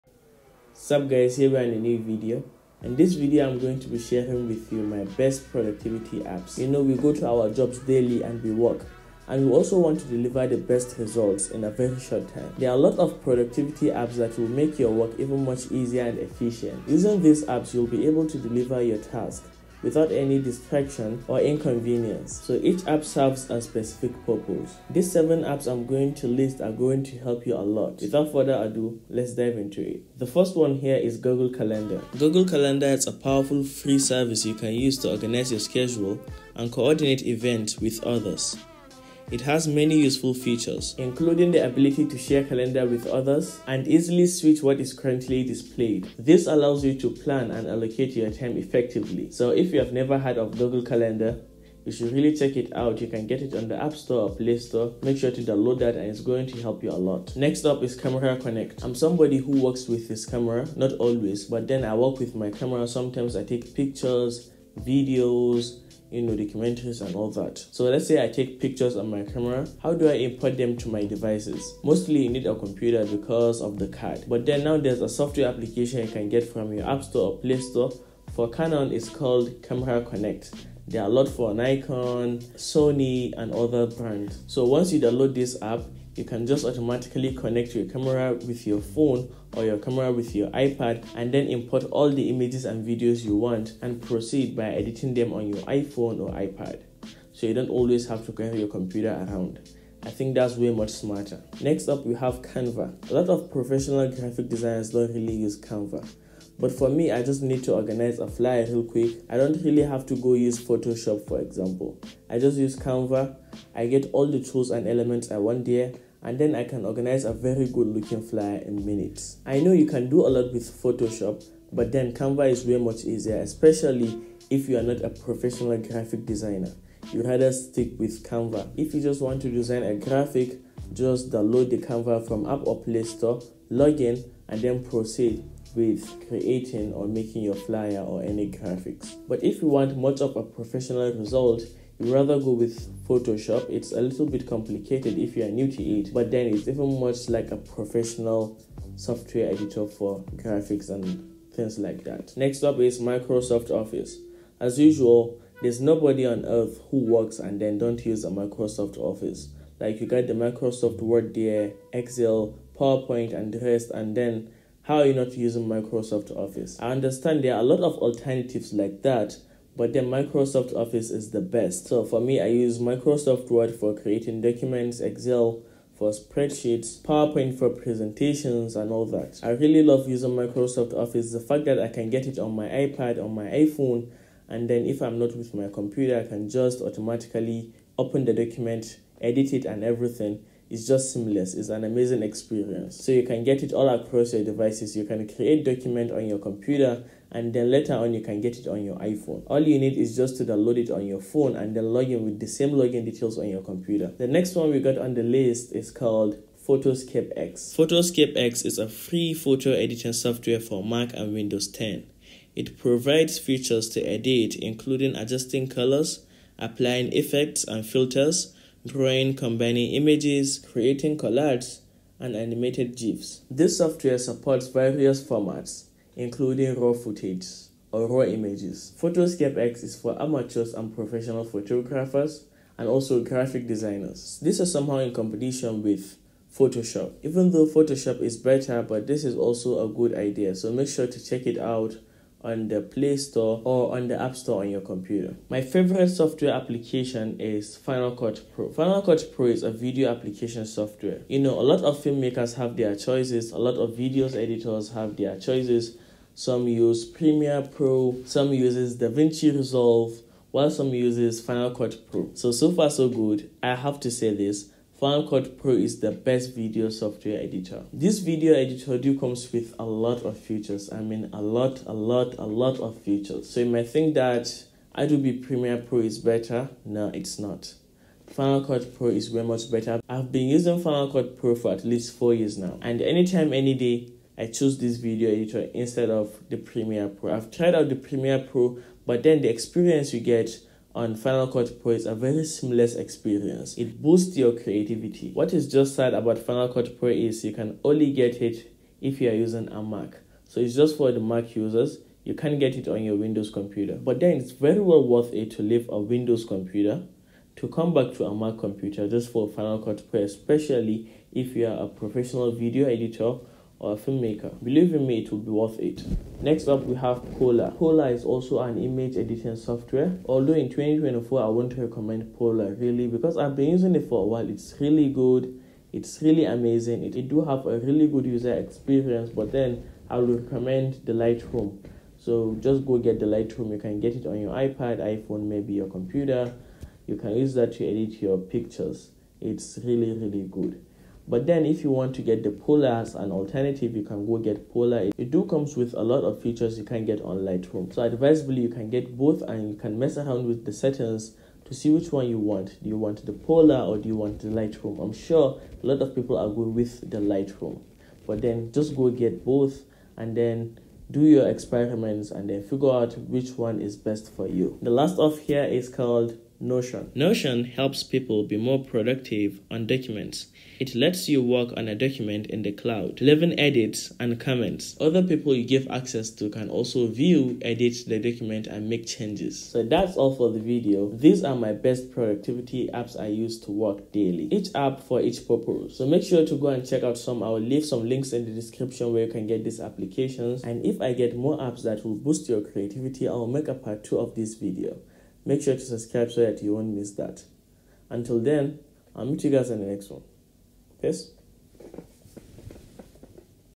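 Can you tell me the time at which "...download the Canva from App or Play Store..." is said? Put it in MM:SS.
02:11.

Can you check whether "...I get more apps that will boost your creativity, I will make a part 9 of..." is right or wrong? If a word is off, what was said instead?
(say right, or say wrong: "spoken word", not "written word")
wrong: "2", not "9".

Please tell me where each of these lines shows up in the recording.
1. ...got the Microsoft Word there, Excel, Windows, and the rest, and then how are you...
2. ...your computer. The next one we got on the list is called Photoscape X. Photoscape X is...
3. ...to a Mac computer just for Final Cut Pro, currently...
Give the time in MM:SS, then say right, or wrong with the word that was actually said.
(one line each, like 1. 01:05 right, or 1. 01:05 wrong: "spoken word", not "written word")
1. 02:40 wrong: "PowerPoint", not "Windows"
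2. 03:23 right
3. 05:08 wrong: "especially", not "currently".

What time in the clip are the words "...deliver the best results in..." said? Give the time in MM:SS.
00:10.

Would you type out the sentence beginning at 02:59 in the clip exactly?
I really love using Microsoft Office.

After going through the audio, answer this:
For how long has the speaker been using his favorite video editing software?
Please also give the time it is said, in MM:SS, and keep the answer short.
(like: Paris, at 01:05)
at least 4 years, at 04:41.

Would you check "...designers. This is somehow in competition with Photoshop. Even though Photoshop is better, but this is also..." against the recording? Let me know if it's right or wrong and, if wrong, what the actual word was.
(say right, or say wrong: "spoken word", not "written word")
right.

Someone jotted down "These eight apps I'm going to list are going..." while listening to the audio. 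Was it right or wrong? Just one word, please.
wrong.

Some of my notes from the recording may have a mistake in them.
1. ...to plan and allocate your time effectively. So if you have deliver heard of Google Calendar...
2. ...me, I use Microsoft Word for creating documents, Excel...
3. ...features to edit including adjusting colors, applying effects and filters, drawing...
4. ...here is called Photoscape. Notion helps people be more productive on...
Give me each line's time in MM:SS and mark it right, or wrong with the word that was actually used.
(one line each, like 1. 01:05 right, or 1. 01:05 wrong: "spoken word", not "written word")
1. 00:46 wrong: "never", not "deliver"
2. 02:52 right
3. 03:33 right
4. 06:05 wrong: "Notion", not "Photoscape".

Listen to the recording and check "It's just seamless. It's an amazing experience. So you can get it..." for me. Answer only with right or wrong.
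right.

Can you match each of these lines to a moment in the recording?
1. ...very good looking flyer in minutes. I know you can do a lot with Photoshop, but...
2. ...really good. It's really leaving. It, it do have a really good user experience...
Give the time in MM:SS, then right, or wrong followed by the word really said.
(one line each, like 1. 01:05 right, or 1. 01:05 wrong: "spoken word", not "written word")
1. 01:57 right
2. 05:24 wrong: "amazing", not "leaving".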